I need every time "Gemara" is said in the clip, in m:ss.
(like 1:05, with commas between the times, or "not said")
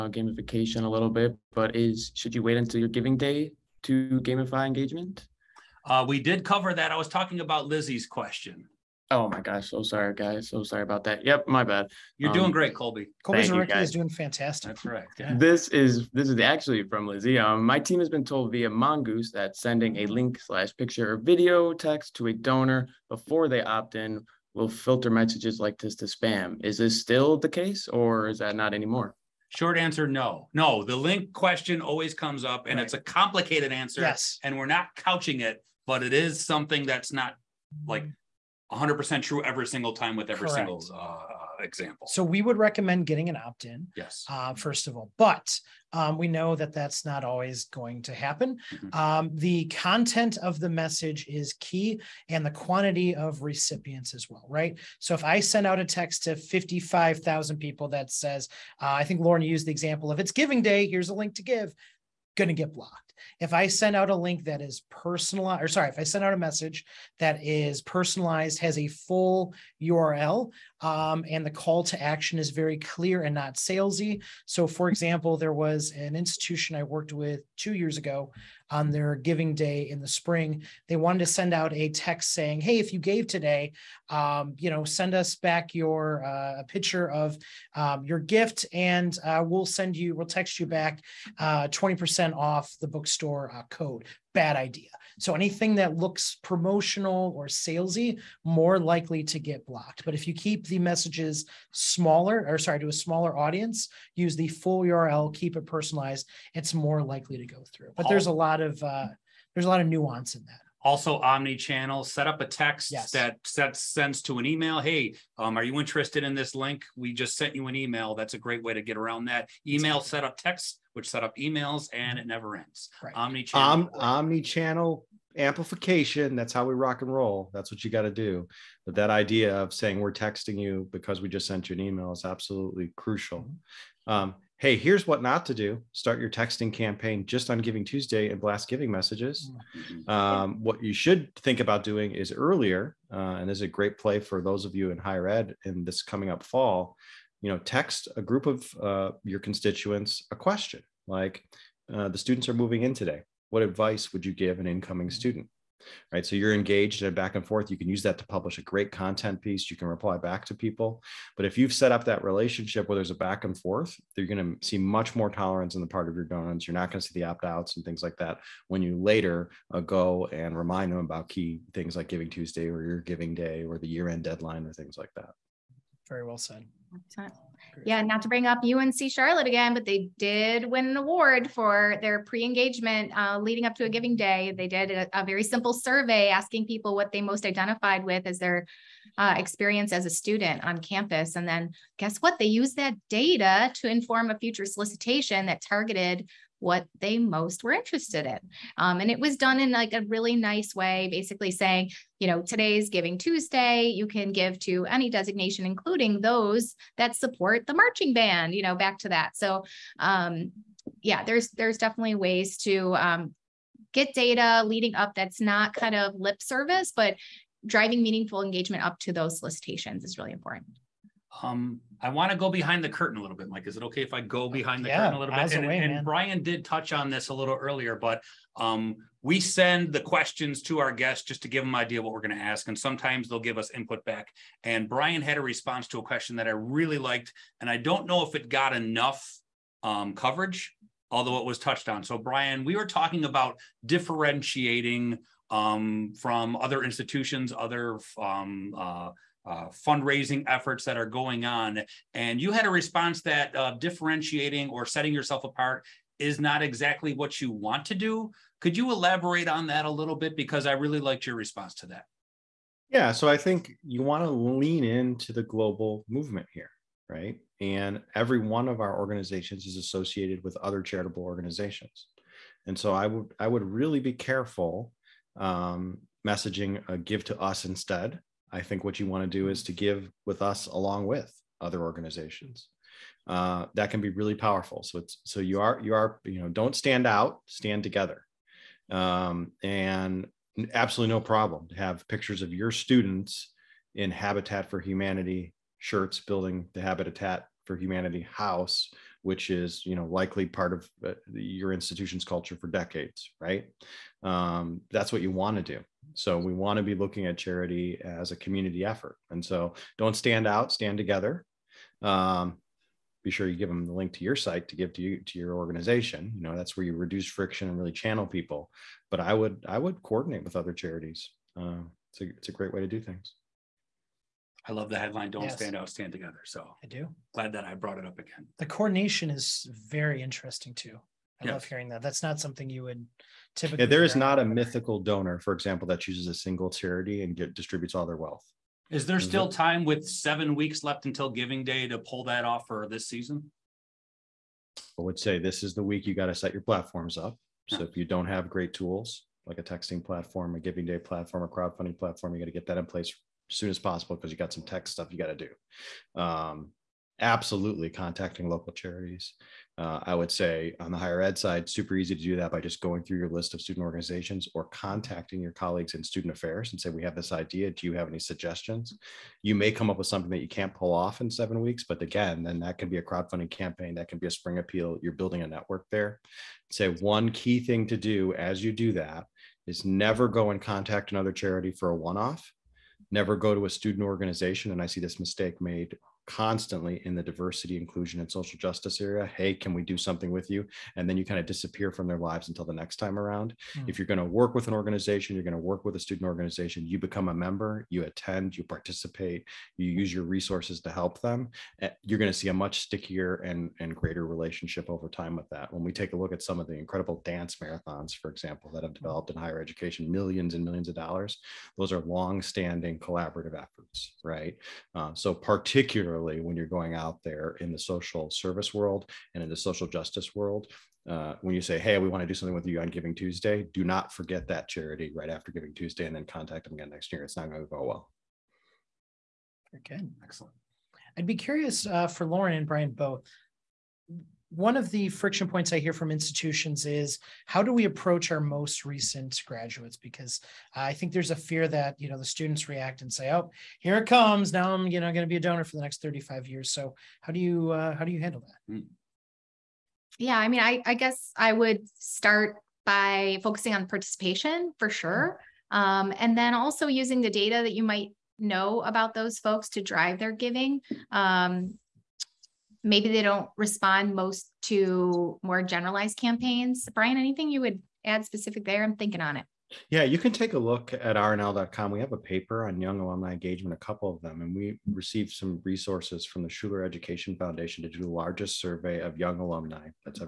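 not said.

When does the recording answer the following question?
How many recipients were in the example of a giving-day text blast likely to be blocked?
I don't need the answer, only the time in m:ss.
0:56.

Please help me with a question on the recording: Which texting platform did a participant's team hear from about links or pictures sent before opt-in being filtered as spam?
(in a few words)
Mongoose.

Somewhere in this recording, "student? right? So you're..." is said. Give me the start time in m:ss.
2:35.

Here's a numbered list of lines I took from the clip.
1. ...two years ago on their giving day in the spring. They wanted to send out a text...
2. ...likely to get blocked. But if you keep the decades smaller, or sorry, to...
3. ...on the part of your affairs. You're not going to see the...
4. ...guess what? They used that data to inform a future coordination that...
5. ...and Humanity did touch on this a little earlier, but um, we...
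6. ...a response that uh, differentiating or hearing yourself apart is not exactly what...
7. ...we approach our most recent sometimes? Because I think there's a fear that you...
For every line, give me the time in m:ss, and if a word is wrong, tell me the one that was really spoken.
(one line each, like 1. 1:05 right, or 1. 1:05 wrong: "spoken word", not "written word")
1. 1:17 right
2. 1:38 wrong: "messages", not "decades"
3. 2:45 wrong: "donors", not "affairs"
4. 3:11 wrong: "solicitation", not "coordination"
5. 3:45 wrong: "Brian", not "Humanity"
6. 4:12 wrong: "setting", not "hearing"
7. 7:17 wrong: "graduates", not "sometimes".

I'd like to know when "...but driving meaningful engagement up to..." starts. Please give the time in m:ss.
3:36.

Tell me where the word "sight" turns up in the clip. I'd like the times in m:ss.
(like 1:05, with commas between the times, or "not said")
not said.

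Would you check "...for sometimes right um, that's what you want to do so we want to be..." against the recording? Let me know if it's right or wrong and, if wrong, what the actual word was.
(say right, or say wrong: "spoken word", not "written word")
wrong: "decades", not "sometimes".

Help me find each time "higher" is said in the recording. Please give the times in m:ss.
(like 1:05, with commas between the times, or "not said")
2:24, 6:00, 6:49.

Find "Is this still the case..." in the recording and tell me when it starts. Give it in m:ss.
0:26.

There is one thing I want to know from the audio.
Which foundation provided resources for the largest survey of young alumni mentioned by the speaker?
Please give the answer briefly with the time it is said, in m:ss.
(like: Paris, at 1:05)
Schuler Education Foundation, at 7:56.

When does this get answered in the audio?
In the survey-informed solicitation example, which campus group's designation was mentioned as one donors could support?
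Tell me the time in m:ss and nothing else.
3:27.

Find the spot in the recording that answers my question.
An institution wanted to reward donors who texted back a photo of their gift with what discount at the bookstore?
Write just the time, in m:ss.
1:31.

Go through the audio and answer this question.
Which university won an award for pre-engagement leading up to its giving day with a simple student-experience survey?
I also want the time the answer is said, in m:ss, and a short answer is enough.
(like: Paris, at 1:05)
UNC Charlotte, at 2:58.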